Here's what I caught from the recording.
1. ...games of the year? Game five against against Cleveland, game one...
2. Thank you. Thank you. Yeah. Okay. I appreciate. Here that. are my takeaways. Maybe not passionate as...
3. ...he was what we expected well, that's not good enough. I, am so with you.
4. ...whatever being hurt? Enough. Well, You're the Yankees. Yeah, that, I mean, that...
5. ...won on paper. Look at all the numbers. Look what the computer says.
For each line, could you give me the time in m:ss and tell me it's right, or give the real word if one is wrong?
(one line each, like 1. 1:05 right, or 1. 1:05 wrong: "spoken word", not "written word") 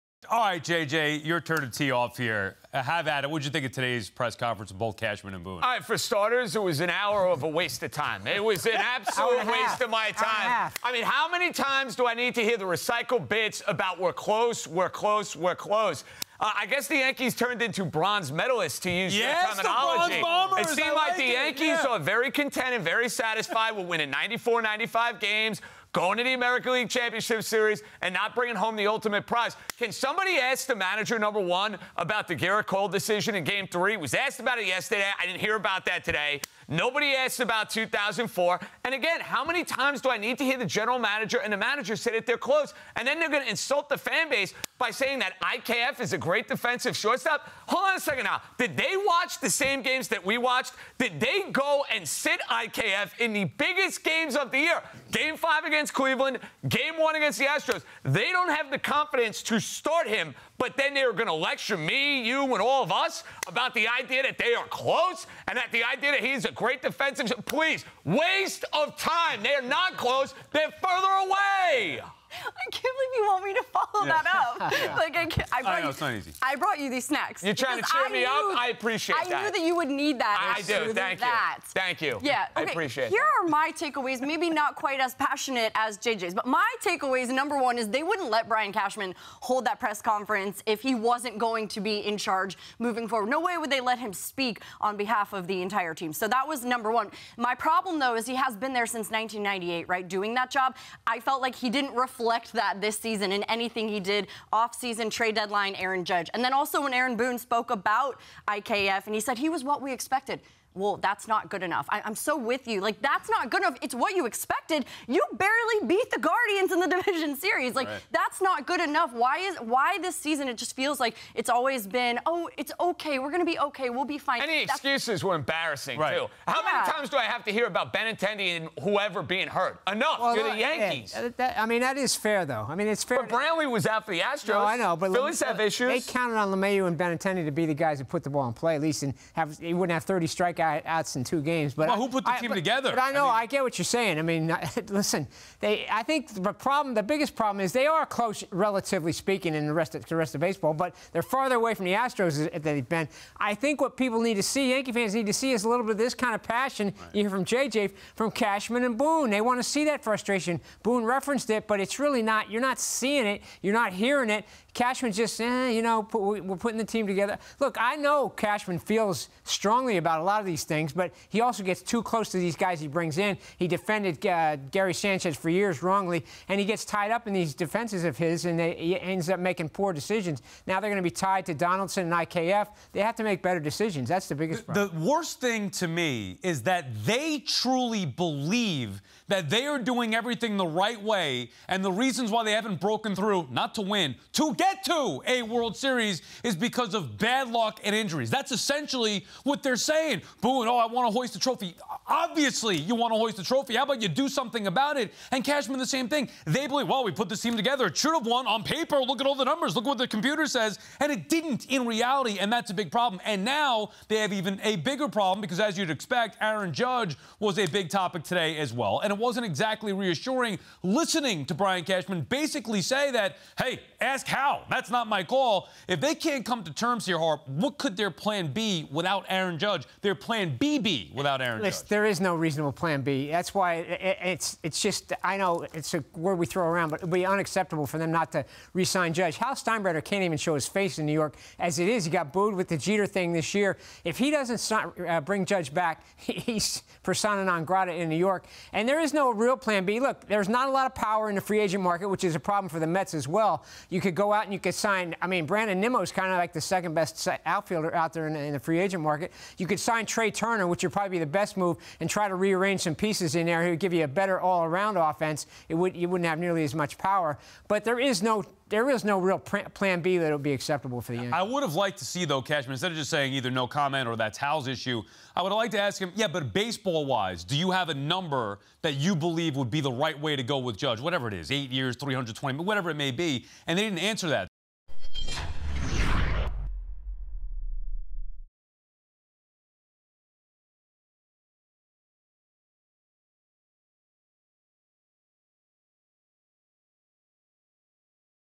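1. 0:54 right
2. 1:20 wrong: "quite", not "passionate"
3. 1:49 right
4. 2:08 wrong: "whoever", not "whatever"
5. 3:28 right.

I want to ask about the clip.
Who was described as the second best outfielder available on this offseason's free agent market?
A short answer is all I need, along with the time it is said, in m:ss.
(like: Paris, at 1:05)
Brandon Nimmo, at 4:15.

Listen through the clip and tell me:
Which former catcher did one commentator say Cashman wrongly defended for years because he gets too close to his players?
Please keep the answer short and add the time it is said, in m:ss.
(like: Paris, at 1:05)
Gary Sanchez, at 2:54.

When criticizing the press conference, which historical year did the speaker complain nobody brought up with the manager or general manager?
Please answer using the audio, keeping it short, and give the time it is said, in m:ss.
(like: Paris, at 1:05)
2004, at 0:37.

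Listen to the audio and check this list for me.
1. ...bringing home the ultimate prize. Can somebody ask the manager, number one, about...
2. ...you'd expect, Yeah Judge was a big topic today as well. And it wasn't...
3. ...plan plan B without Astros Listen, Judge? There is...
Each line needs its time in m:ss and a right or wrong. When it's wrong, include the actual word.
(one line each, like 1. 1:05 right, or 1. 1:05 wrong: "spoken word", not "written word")
1. 0:28 right
2. 3:35 wrong: "Aaron", not "Yeah"
3. 3:50 wrong: "Aaron", not "Astros".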